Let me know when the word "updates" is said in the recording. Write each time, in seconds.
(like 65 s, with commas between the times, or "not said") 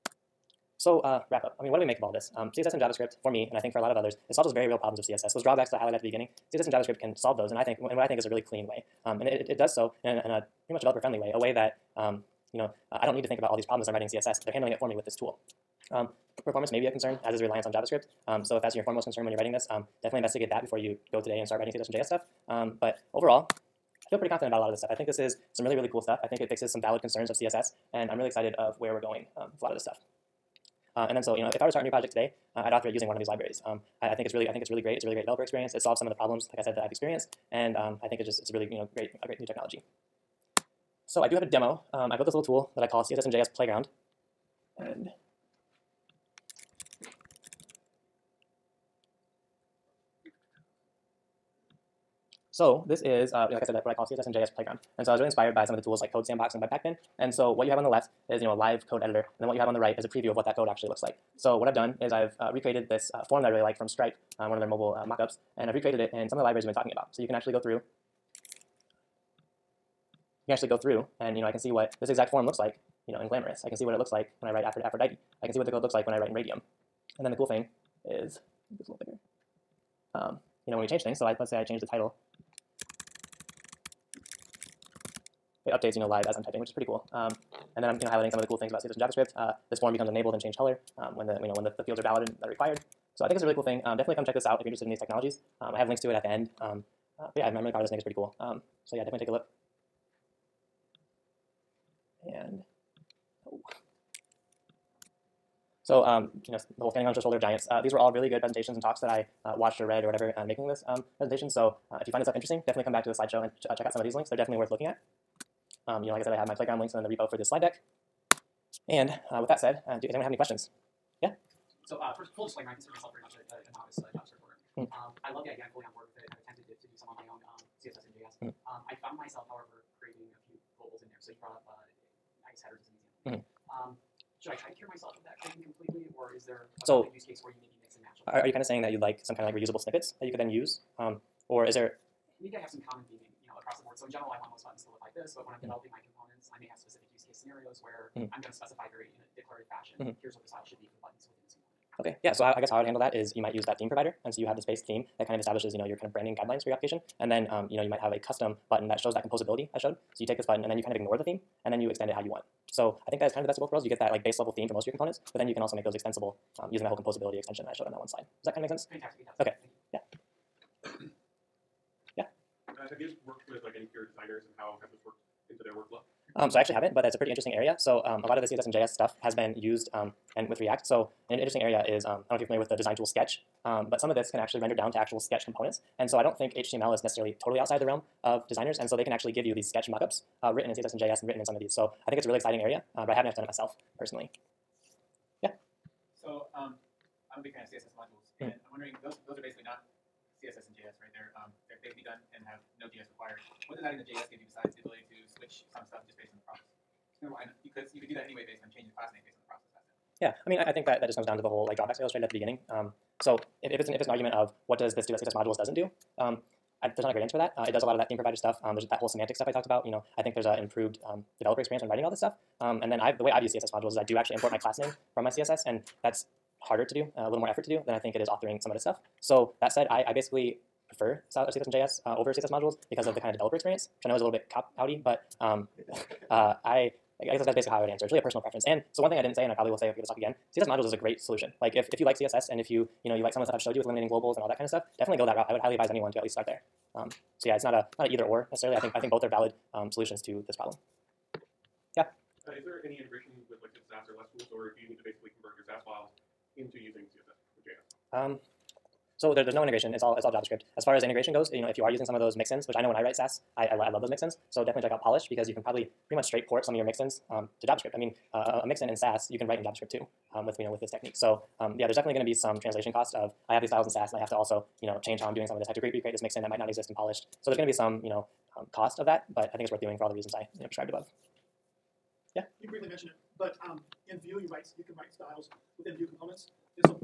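85 s.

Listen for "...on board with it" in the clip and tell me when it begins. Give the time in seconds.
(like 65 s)
125 s.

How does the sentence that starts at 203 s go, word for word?
What does adding the JS give you besides the ability switch some stuff just based on the process.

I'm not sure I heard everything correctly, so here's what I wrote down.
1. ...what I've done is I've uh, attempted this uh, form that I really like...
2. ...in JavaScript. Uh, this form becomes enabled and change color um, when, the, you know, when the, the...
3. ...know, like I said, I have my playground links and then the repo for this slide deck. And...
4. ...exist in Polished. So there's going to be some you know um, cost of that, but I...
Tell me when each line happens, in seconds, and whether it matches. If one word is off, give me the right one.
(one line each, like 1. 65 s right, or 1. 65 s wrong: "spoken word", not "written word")
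1. 61 s wrong: "recreated", not "attempted"
2. 88 s right
3. 116 s right
4. 276 s right.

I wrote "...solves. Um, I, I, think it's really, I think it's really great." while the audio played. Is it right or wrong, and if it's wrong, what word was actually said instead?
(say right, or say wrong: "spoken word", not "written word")
wrong: "libraries", not "solves".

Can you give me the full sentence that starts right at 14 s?
They're handling it for me with this tool.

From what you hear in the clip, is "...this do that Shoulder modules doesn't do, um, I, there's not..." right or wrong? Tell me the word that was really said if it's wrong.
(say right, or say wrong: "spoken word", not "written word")
wrong: "CSS", not "Shoulder".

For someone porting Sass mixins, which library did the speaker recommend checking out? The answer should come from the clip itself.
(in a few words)
Polished.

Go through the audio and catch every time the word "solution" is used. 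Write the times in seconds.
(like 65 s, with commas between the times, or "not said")
241 s, 249 s.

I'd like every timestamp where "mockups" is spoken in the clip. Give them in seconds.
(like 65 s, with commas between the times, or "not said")
65 s, 189 s.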